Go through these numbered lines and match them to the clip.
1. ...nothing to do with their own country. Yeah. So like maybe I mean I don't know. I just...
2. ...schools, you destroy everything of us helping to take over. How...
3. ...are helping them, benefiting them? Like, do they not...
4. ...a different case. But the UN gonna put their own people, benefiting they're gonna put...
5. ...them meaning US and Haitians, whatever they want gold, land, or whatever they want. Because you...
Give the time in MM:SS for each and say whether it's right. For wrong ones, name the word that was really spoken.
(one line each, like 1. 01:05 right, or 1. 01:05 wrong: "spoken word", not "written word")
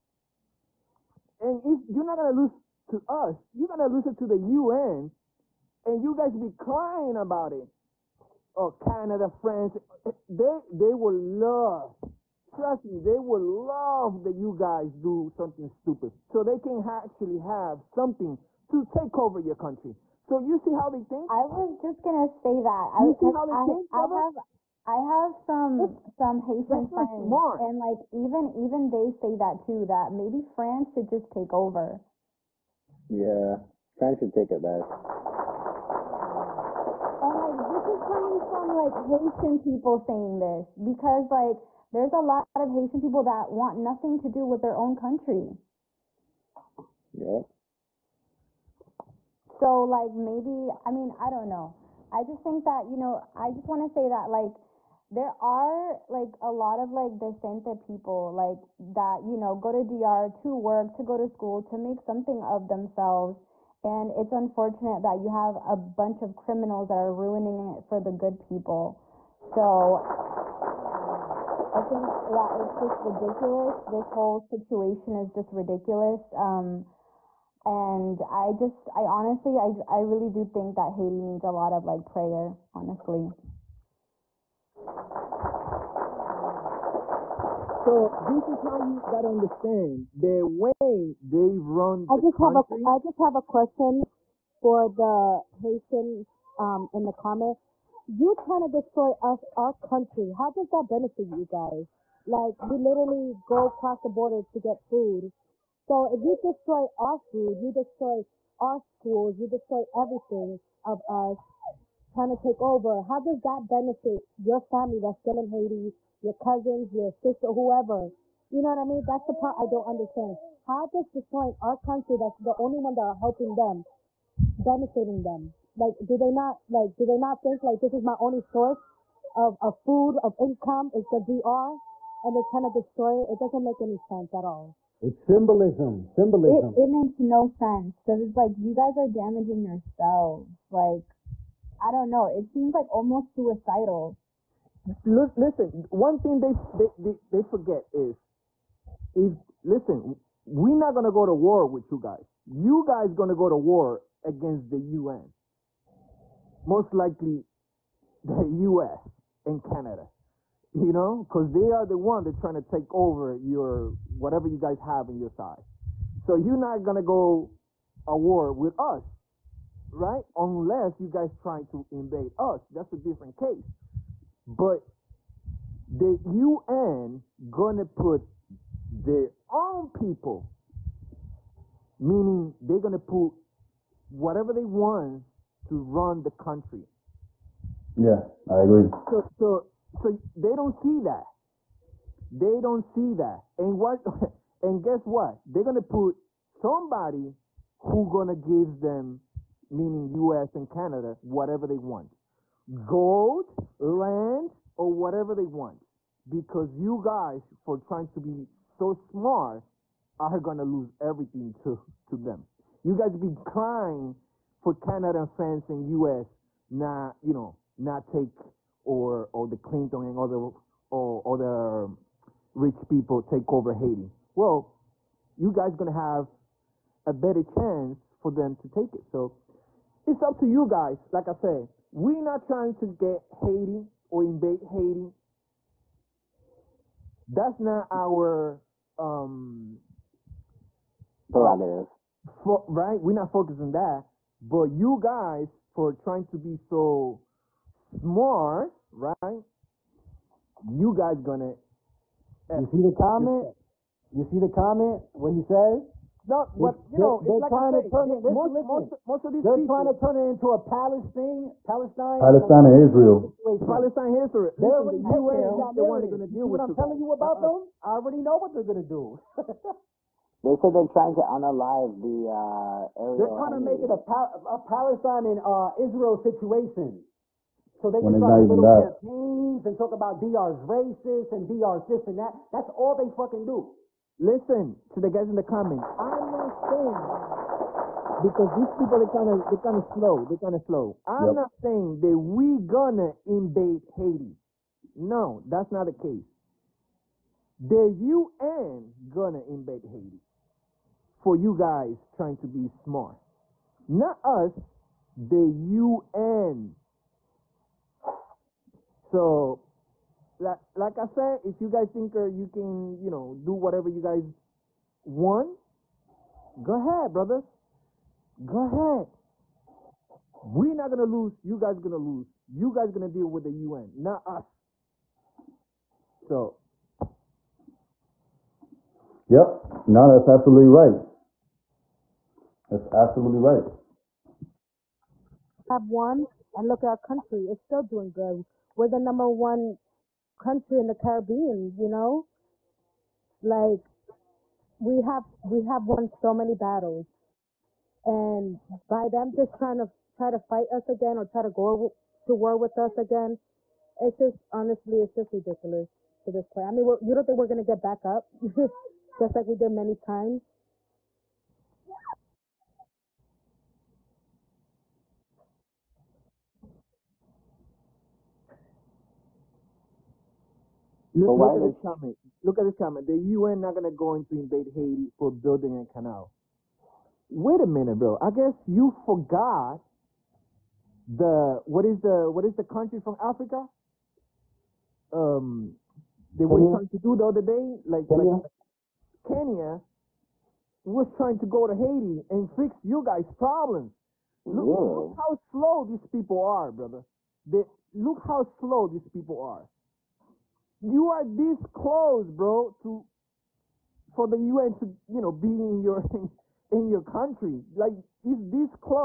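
1. 00:43 right
2. 01:48 wrong: "trying", not "helping"
3. 02:03 right
4. 02:52 wrong: "meaning", not "benefiting"
5. 03:18 wrong: "Canada", not "Haitians".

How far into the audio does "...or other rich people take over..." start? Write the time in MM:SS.
03:40.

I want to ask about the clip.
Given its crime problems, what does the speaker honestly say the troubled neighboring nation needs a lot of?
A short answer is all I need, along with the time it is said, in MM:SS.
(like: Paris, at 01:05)
prayer, at 01:22.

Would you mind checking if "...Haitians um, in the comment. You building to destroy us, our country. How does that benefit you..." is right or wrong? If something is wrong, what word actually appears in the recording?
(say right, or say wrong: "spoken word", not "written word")
wrong: "trying", not "building".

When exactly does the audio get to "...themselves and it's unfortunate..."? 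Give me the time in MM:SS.
01:02.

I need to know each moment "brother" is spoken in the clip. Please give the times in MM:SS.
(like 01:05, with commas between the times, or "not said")
00:23, 05:17, 06:36.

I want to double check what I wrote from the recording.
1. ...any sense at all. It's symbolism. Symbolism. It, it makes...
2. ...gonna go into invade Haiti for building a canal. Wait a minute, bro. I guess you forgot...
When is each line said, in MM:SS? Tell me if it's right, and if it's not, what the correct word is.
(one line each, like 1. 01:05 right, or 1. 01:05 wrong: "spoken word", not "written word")
1. 02:13 right
2. 06:13 right.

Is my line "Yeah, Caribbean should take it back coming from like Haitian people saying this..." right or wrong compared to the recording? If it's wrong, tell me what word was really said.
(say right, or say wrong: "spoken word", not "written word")
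wrong: "France", not "Caribbean".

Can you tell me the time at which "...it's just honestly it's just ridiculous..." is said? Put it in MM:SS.
05:53.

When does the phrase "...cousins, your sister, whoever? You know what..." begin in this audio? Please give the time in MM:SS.
01:56.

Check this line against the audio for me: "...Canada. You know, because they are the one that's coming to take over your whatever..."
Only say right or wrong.
wrong.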